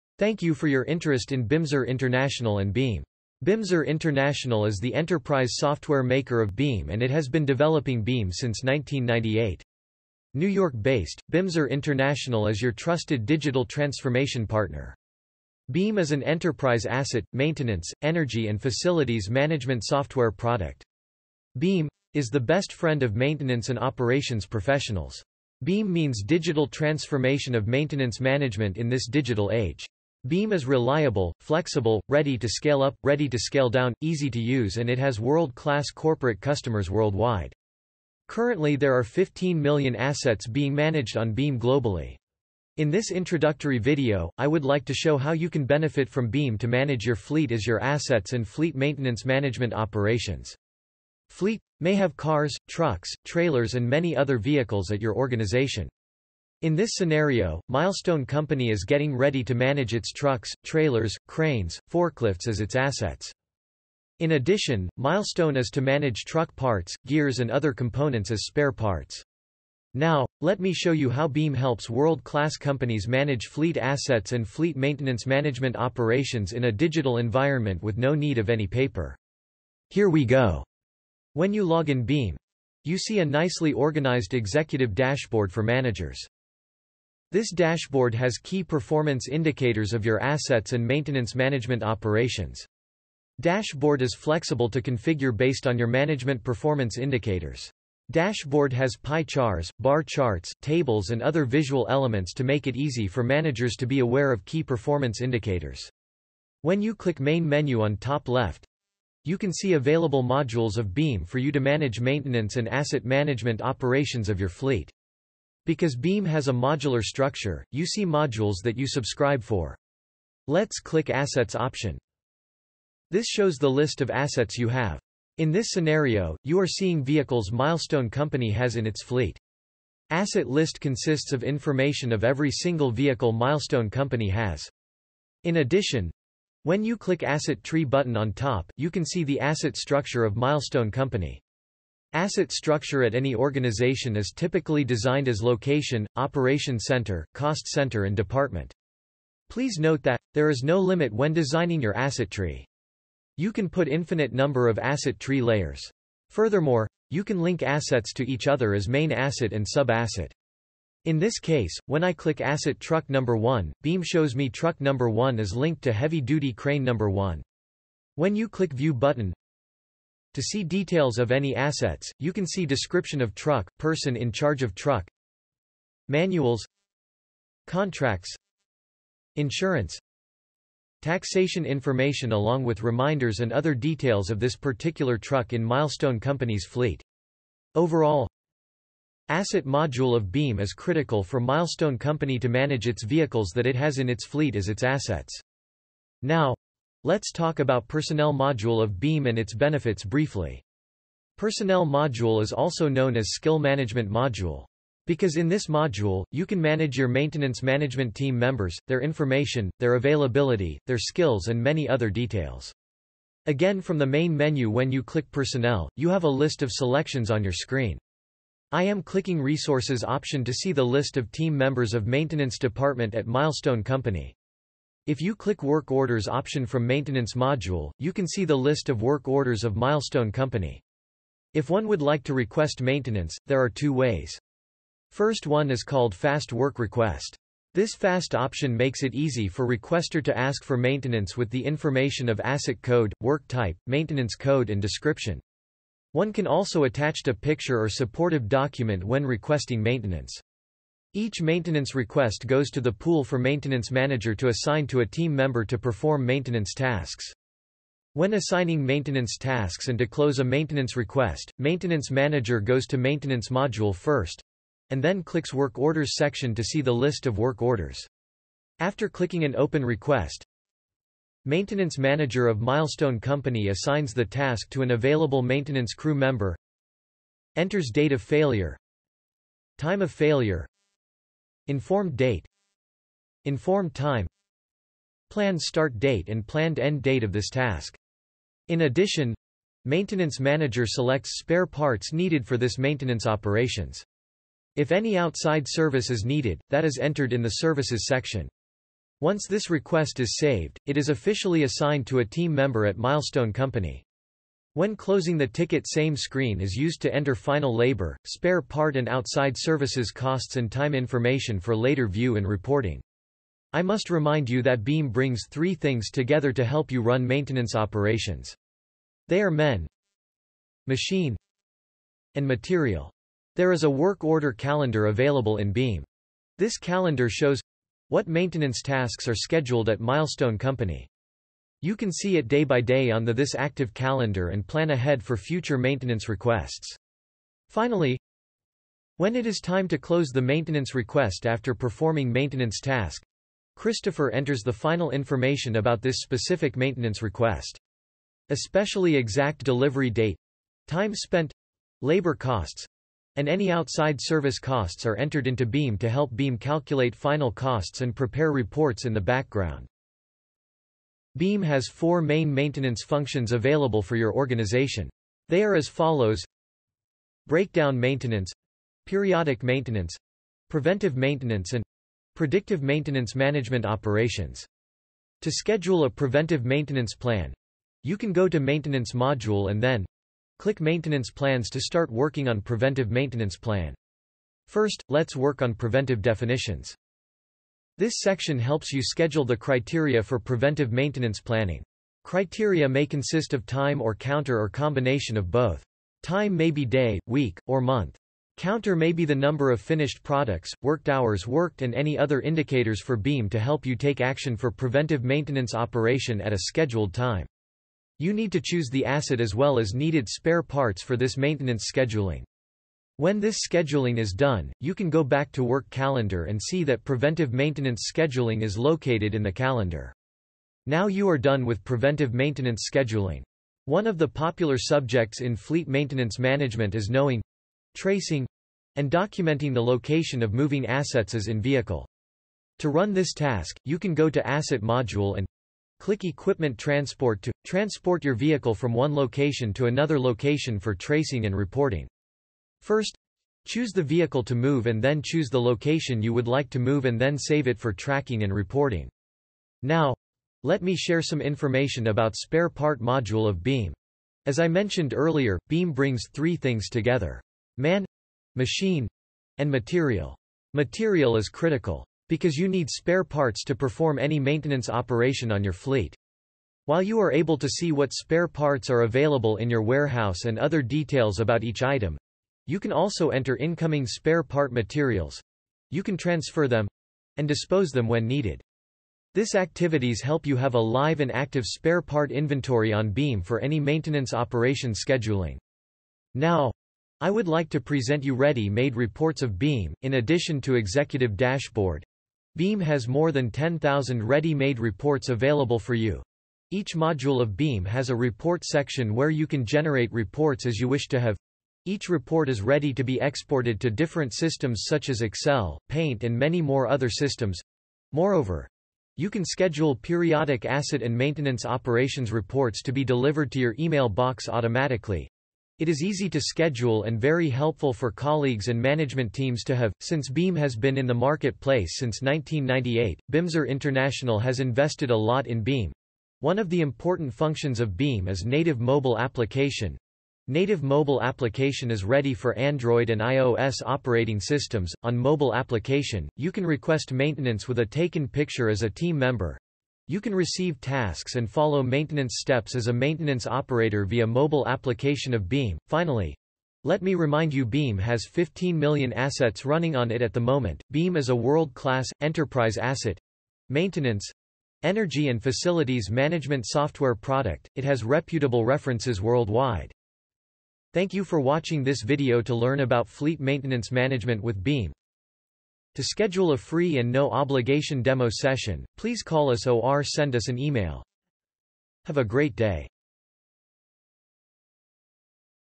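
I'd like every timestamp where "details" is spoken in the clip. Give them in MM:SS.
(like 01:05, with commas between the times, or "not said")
02:50, 03:03, 03:32, 07:50.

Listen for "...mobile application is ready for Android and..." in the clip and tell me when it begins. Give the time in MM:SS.
08:50.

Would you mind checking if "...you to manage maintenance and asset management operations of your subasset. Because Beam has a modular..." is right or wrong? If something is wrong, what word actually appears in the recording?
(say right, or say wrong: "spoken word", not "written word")
wrong: "fleet", not "subasset".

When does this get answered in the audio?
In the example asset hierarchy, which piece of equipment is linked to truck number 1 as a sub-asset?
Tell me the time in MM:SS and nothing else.
02:45.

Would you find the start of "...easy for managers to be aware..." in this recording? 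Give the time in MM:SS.
01:42.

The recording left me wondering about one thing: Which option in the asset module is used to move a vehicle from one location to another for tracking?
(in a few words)
Equipment Transport.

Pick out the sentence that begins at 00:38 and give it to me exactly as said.
Currently there are 15 million assets being managed on Beam globally.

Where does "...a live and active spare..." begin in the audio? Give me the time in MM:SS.
08:00.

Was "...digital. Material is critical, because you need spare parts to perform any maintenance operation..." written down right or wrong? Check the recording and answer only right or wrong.
wrong.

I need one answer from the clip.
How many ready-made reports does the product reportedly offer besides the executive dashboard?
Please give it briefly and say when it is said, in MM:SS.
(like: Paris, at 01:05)
10,000, at 08:13.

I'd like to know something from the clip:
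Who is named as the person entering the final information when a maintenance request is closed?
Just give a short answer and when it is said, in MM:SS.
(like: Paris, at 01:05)
Christopher, at 05:43.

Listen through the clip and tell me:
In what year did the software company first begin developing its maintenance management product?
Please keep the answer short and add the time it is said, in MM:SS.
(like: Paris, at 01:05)
1998, at 00:07.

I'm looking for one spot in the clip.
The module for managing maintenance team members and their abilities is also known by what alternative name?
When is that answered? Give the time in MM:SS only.
03:23.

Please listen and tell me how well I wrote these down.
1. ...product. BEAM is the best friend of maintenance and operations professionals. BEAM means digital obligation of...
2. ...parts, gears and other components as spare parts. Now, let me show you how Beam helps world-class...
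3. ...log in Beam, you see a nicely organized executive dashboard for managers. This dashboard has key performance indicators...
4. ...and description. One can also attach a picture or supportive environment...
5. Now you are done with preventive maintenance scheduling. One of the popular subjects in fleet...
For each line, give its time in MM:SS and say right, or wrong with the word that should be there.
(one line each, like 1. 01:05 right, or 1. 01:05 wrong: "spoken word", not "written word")
1. 00:20 wrong: "transformation", not "obligation"
2. 01:06 right
3. 01:21 right
4. 04:04 wrong: "document", not "environment"
5. 07:00 right.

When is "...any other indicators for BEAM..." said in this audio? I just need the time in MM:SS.
06:41.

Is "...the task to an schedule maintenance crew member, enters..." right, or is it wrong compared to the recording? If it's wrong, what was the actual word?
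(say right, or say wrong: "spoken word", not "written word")
wrong: "available", not "schedule".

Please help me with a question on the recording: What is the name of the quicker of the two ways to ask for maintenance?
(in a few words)
Fast Work Request.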